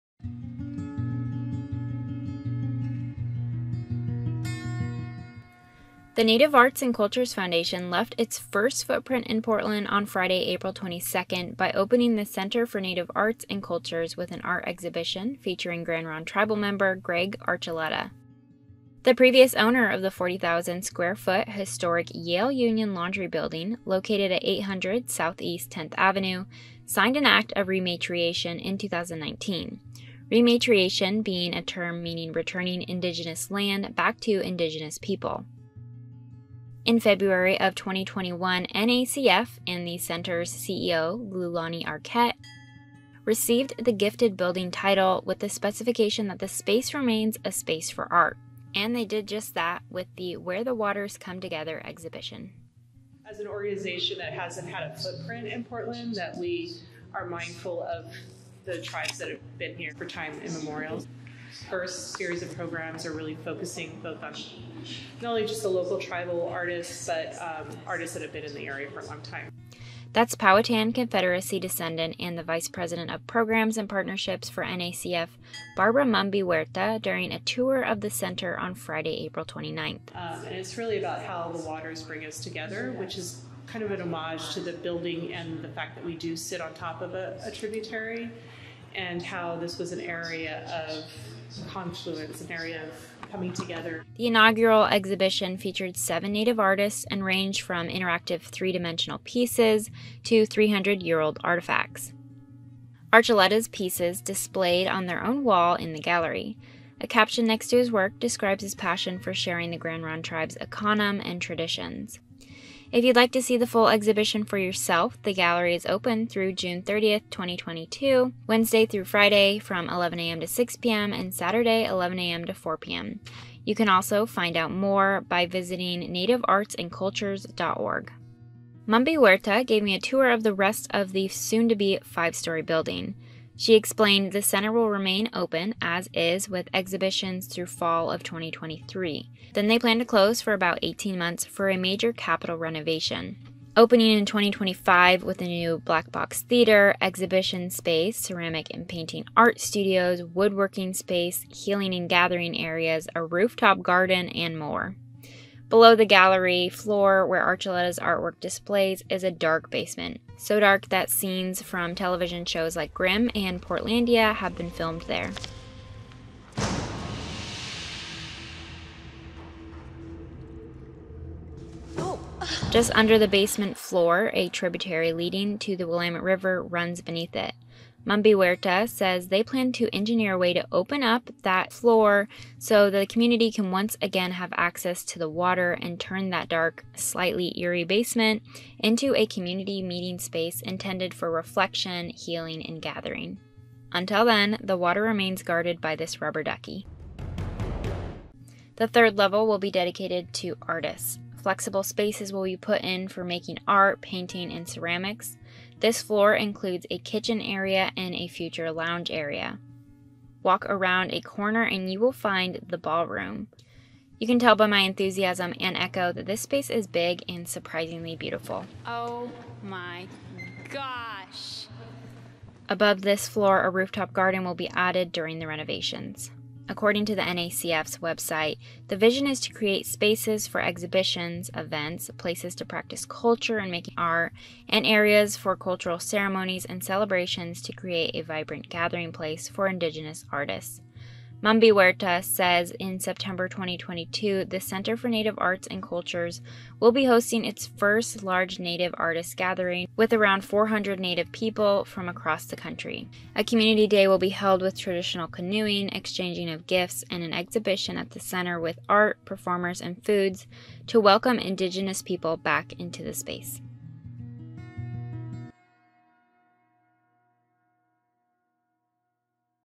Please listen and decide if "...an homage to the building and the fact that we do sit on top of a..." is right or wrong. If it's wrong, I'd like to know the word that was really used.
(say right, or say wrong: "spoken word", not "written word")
right.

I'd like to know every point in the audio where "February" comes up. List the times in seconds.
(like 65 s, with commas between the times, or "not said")
36 s.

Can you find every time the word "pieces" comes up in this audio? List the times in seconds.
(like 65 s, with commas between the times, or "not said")
99 s, 103 s.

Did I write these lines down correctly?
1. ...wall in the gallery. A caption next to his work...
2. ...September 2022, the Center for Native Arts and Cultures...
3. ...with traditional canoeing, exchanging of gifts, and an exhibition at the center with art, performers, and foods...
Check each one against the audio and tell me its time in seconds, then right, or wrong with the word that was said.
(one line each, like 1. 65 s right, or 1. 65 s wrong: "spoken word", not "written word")
1. 105 s right
2. 242 s right
3. 254 s right.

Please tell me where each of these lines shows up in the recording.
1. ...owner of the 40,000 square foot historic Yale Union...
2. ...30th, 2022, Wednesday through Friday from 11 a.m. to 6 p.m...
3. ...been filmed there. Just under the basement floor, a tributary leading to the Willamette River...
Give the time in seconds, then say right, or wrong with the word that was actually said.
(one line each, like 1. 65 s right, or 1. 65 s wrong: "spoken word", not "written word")
1. 19 s right
2. 116 s right
3. 164 s right.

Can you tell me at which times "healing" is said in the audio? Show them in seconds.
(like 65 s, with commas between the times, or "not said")
151 s, 192 s.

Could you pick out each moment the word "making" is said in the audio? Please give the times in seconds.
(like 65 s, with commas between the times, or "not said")
203 s, 233 s.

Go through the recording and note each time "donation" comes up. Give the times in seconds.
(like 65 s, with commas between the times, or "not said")
not said.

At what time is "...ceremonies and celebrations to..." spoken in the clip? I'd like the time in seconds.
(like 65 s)
235 s.